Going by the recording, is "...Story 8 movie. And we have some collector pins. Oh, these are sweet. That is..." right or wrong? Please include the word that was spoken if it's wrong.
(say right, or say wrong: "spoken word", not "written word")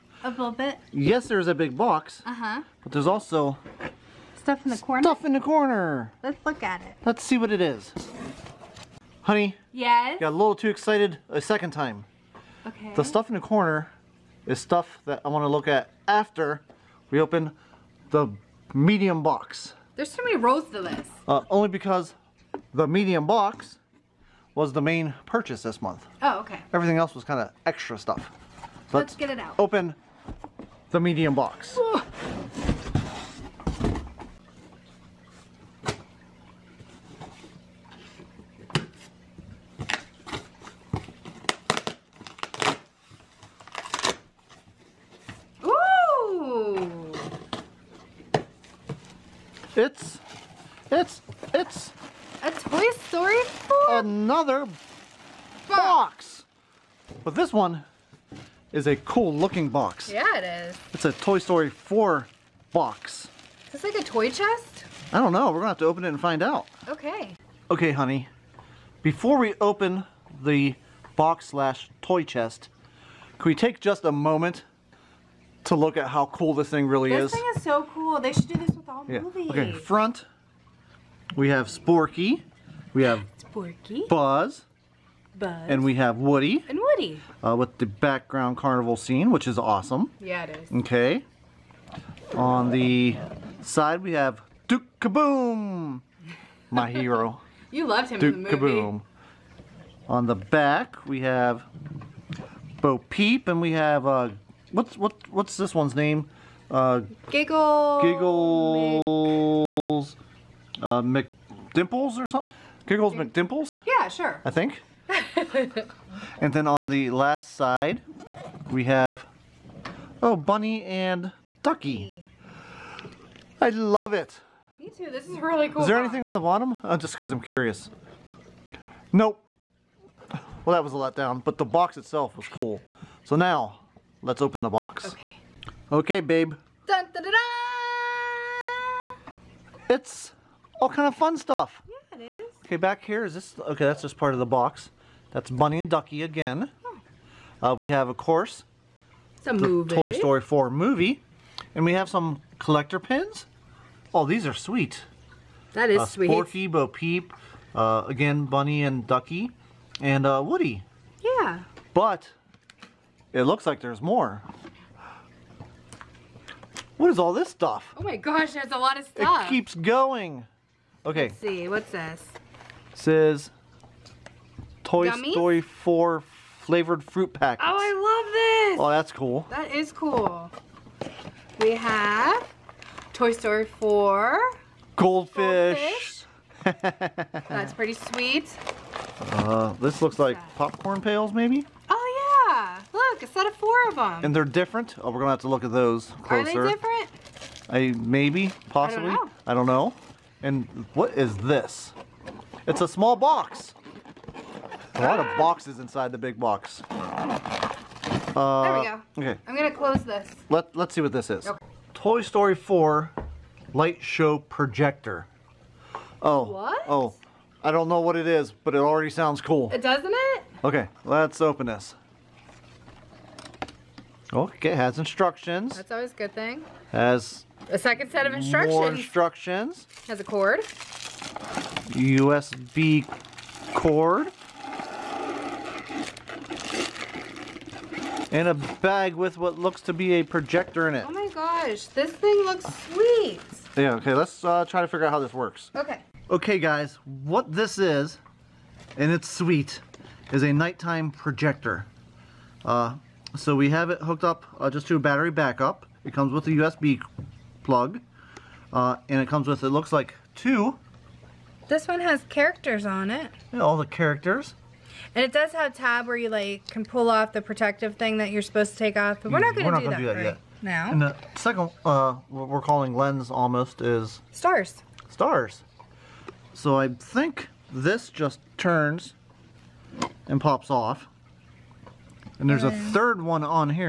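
wrong: "4", not "8".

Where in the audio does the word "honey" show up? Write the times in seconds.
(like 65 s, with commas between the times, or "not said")
9 s, 67 s.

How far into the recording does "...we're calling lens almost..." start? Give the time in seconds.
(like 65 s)
272 s.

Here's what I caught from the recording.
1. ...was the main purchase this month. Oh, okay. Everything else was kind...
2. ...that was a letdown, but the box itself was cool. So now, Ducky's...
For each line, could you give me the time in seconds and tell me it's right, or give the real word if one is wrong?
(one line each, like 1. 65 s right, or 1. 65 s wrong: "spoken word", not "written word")
1. 24 s right
2. 130 s wrong: "Let", not "Ducky".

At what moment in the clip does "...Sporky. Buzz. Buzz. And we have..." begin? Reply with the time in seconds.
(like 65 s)
83 s.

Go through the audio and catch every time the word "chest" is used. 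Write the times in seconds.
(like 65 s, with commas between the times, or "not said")
64 s, 72 s.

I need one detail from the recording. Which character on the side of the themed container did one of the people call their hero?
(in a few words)
Duke Kaboom.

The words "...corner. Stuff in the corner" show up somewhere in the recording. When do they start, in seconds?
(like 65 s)
4 s.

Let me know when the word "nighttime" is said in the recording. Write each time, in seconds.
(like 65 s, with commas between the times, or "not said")
250 s.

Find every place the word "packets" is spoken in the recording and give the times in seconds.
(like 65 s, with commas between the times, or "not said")
177 s.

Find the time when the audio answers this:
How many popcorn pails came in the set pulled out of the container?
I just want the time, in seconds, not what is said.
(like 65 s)
193 s.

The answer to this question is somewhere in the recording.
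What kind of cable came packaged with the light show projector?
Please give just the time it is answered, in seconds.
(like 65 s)
231 s.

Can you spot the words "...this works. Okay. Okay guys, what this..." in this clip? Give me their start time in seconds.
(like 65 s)
245 s.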